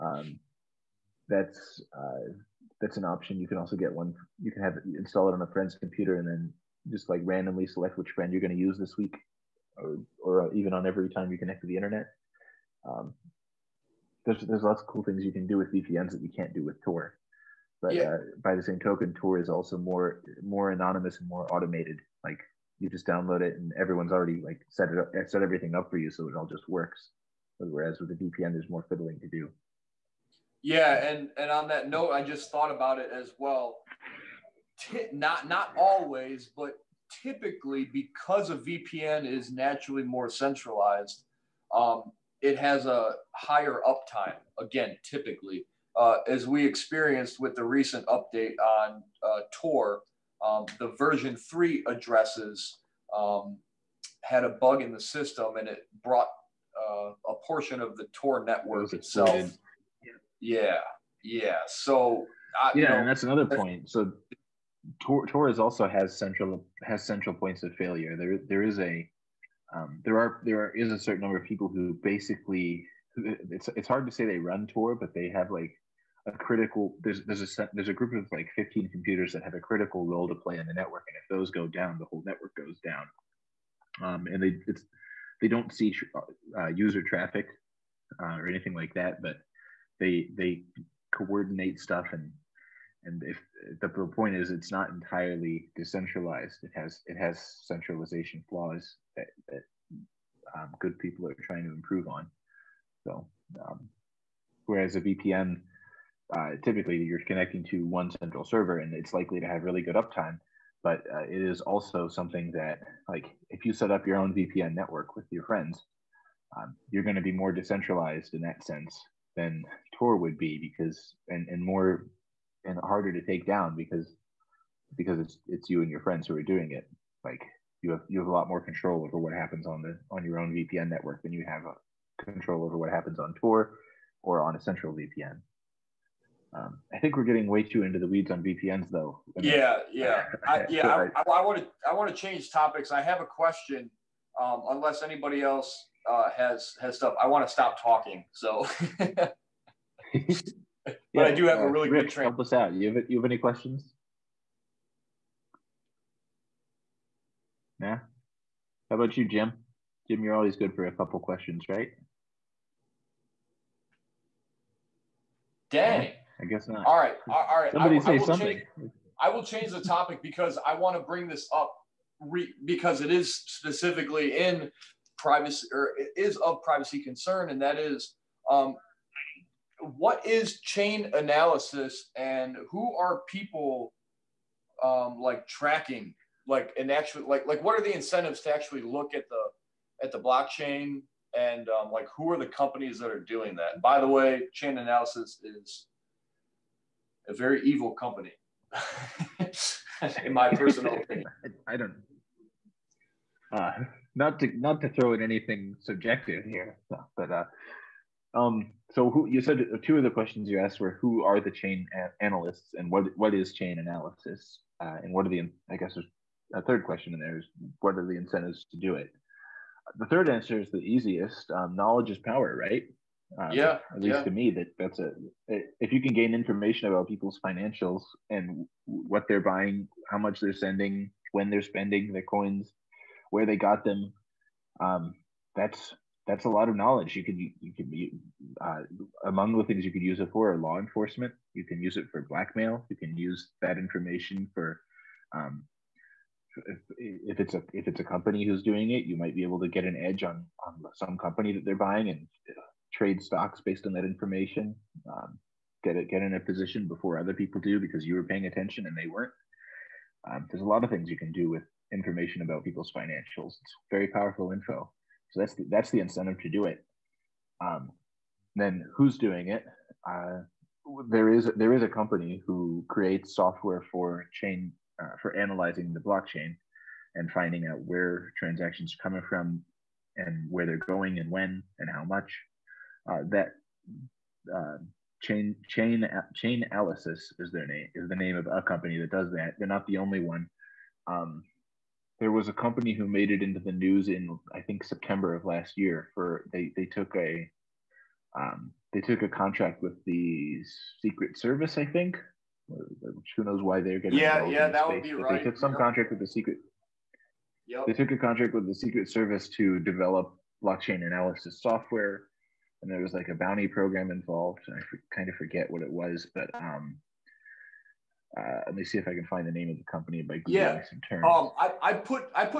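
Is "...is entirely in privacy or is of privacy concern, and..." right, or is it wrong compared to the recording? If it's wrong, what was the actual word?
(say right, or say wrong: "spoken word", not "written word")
wrong: "specifically", not "entirely".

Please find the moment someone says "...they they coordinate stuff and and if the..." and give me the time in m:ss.
1:29.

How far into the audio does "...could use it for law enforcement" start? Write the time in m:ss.
3:59.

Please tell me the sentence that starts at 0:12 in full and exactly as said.
Um, there's there's lots of cool things you can do with VPNs that you can't do with Tor.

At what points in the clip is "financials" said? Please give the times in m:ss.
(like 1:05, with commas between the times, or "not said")
3:47, 4:22.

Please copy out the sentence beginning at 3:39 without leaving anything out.
The third answer is the easiest.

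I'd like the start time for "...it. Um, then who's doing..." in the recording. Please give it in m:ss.
4:26.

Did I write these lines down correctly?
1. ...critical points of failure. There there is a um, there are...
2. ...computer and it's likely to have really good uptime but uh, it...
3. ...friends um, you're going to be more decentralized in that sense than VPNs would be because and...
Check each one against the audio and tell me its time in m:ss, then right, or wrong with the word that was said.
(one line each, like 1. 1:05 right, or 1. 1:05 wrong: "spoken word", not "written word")
1. 1:07 wrong: "central", not "critical"
2. 1:48 wrong: "server", not "computer"
3. 1:55 wrong: "Tor", not "VPNs".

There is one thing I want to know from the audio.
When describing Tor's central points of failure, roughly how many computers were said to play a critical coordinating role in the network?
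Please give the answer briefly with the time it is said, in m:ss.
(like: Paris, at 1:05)
15, at 1:18.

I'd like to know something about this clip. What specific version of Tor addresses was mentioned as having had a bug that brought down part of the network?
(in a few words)
version three.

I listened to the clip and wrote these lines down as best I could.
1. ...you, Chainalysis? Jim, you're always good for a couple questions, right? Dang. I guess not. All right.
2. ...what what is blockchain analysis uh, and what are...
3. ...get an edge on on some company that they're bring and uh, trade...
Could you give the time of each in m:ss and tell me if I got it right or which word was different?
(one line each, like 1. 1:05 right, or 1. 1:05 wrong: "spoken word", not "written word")
1. 2:39 wrong: "Jim", not "Chainalysis"
2. 3:32 wrong: "chain", not "blockchain"
3. 4:09 wrong: "buying", not "bring".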